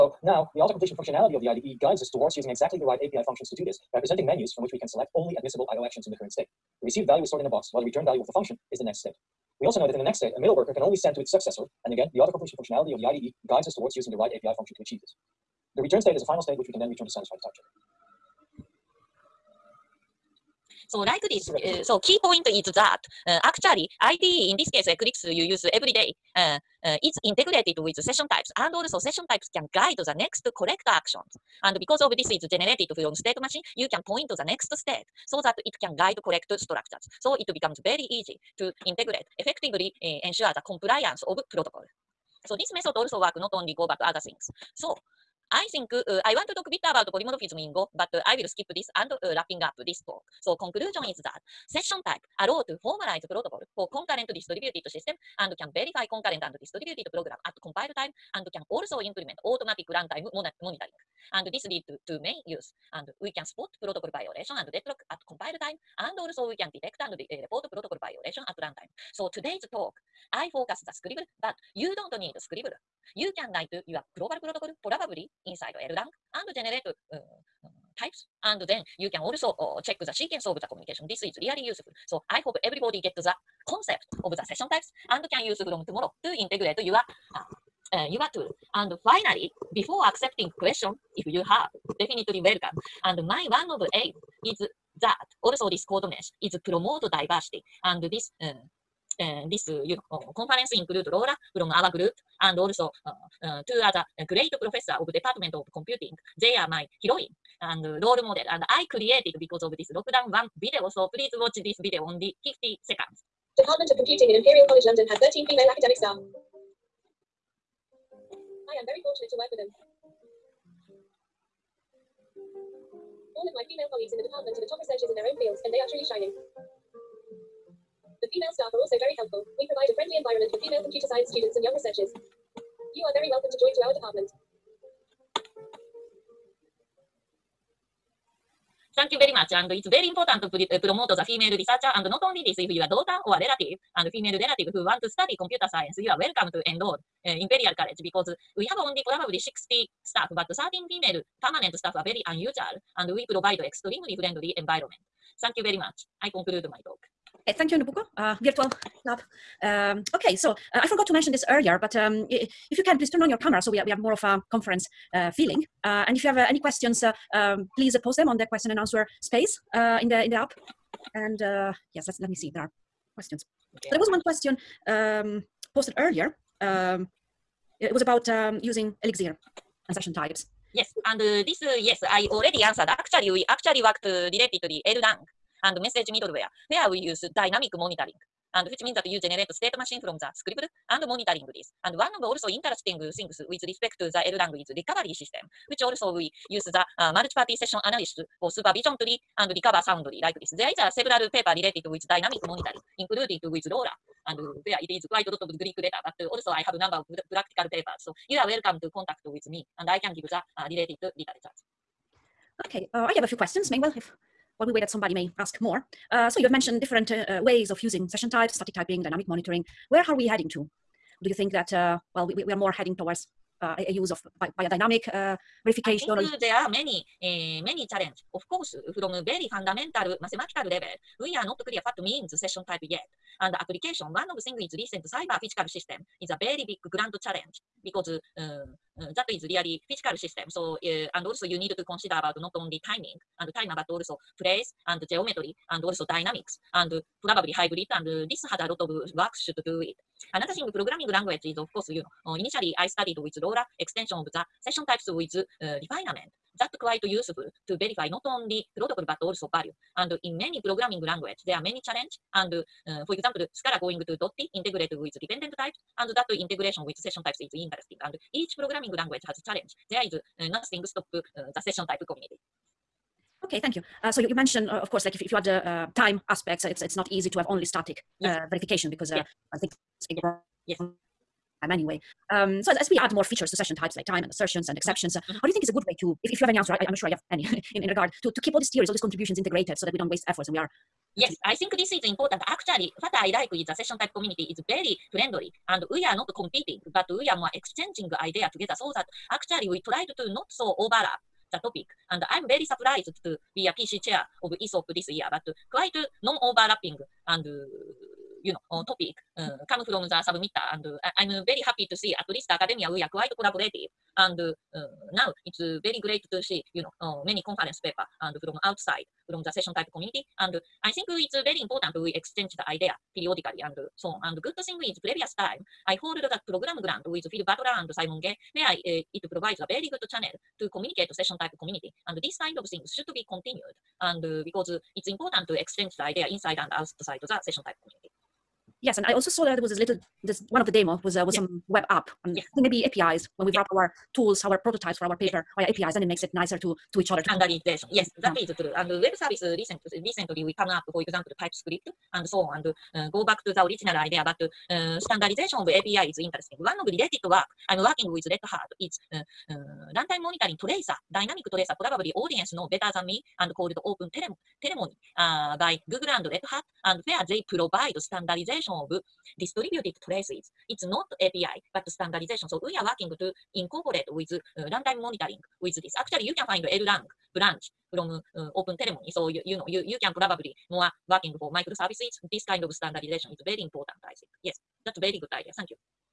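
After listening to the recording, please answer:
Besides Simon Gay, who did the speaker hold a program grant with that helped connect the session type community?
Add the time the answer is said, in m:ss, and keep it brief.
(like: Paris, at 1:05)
Phil Wadler, at 5:27.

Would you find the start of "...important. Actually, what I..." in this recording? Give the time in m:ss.
4:52.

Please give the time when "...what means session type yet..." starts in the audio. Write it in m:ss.
3:51.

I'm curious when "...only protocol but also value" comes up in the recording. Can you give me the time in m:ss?
4:18.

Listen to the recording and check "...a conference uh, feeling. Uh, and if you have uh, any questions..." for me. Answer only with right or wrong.
right.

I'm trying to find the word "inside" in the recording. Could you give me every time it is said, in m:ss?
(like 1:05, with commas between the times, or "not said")
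1:15, 5:36.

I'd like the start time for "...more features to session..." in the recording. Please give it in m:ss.
4:43.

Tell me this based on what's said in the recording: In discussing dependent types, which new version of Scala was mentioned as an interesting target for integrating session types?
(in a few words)
Dotty.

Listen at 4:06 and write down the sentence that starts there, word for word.
And probably hybrid and this has a lot of work should do it.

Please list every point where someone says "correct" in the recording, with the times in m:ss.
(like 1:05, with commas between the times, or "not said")
0:30, 0:36.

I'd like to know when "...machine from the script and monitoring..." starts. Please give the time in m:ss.
3:09.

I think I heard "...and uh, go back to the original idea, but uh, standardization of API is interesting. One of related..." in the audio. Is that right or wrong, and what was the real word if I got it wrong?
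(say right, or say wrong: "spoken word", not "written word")
right.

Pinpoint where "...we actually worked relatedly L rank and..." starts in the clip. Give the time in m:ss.
3:03.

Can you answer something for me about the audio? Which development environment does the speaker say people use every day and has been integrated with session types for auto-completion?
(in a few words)
Eclipse.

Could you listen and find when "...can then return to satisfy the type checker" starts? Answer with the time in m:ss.
0:16.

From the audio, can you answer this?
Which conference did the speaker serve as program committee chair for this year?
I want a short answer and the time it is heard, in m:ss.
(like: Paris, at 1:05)
ESOP, at 5:04.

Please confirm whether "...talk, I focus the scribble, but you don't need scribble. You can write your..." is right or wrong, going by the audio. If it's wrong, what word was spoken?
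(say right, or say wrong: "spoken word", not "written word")
right.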